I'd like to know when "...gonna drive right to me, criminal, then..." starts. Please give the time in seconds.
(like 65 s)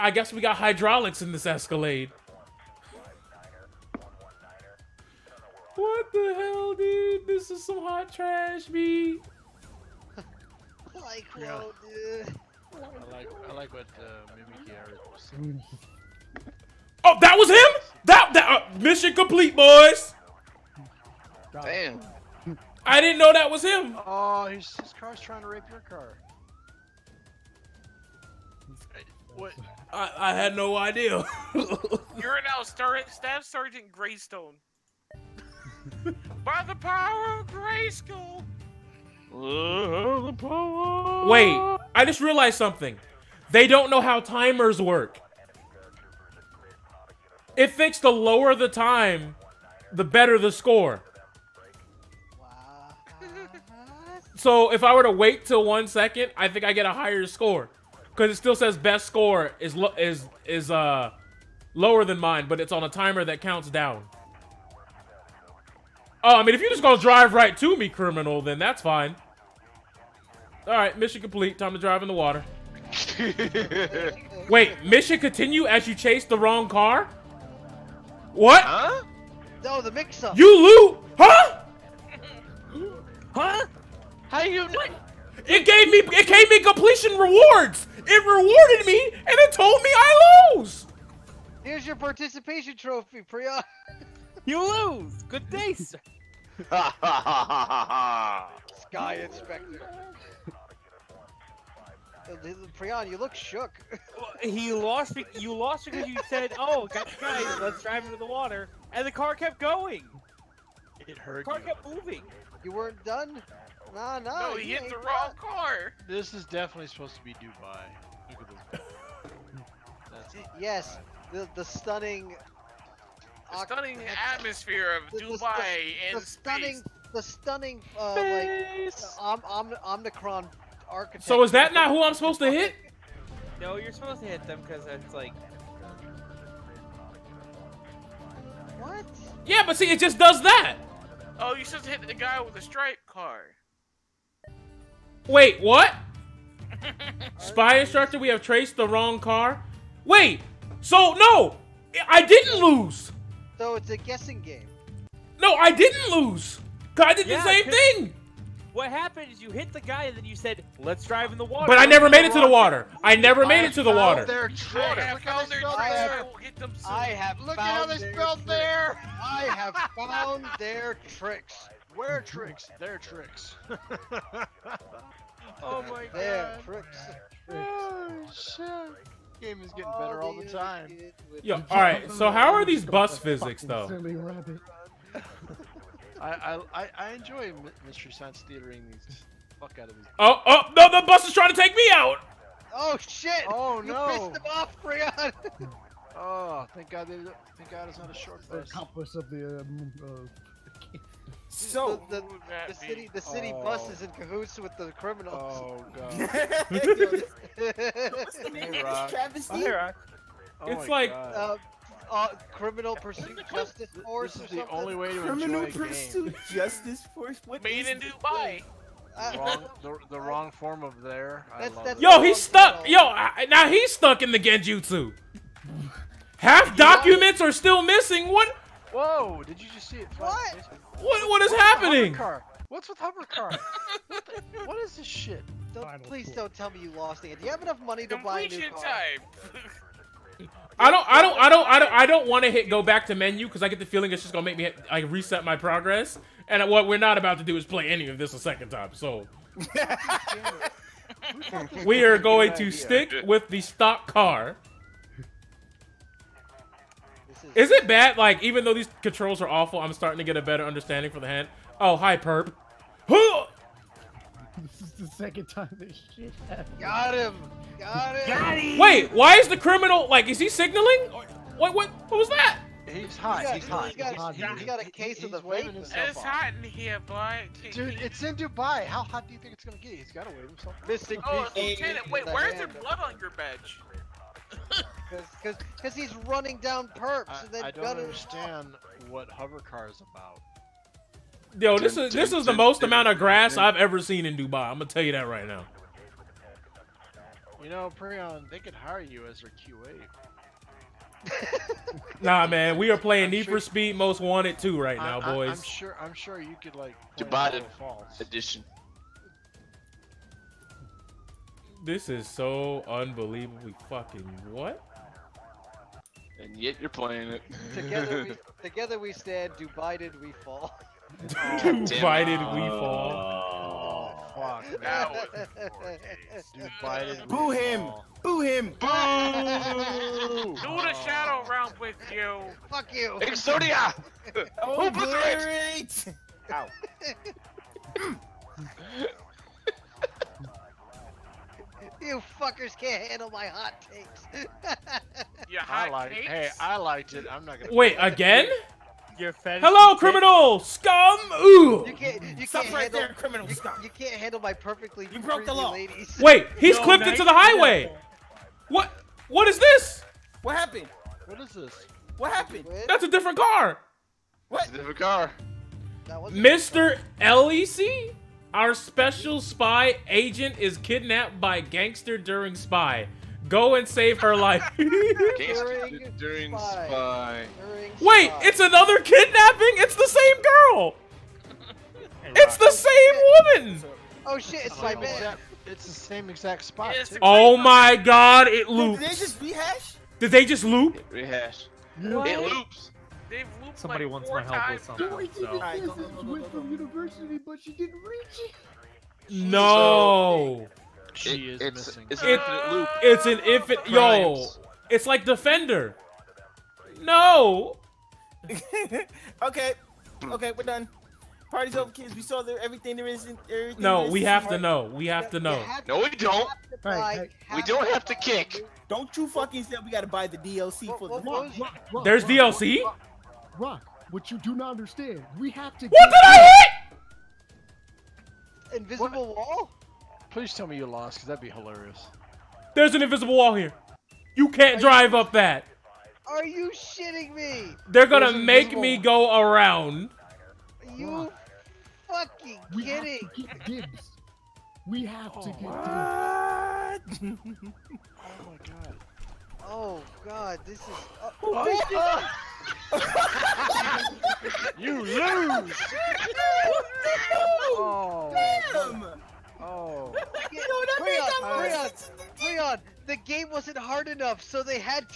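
66 s.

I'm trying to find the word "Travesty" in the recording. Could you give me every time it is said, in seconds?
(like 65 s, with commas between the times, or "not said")
209 s.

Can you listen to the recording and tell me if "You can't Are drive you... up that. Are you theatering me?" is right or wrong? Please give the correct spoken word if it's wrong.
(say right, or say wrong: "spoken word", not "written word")
wrong: "shitting", not "theatering".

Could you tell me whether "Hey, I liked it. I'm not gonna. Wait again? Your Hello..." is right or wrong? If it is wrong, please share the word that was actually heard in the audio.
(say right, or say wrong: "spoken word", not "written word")
right.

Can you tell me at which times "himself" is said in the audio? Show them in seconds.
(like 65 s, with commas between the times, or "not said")
275 s, 280 s.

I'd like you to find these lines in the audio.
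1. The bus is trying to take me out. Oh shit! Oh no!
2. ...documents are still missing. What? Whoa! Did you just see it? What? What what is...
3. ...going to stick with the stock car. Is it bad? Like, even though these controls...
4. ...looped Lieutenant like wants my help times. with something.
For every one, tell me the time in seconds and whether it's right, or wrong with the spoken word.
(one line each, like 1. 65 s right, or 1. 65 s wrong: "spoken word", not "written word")
1. 190 s right
2. 226 s right
3. 252 s right
4. 393 s wrong: "Somebody", not "Lieutenant".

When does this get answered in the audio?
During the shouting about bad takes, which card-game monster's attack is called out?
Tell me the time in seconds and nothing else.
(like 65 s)
333 s.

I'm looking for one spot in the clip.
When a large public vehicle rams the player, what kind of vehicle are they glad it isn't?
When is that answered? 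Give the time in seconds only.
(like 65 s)
198 s.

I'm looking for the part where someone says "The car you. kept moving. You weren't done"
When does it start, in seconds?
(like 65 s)
111 s.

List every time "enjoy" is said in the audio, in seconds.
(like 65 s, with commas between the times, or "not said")
187 s, 215 s.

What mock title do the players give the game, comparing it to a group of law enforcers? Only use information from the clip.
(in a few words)
criminal pursuit justice force.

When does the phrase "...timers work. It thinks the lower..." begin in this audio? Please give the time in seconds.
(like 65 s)
44 s.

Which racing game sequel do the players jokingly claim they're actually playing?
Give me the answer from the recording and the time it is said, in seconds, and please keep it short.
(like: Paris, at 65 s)
Need for Speed Most Wanted 2, at 303 s.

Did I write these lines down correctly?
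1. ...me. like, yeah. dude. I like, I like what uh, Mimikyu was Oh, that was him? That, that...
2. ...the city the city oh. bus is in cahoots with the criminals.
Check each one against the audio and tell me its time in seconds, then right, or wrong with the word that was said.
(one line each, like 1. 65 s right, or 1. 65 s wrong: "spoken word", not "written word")
1. 8 s right
2. 202 s right.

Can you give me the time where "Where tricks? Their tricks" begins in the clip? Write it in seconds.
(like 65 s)
171 s.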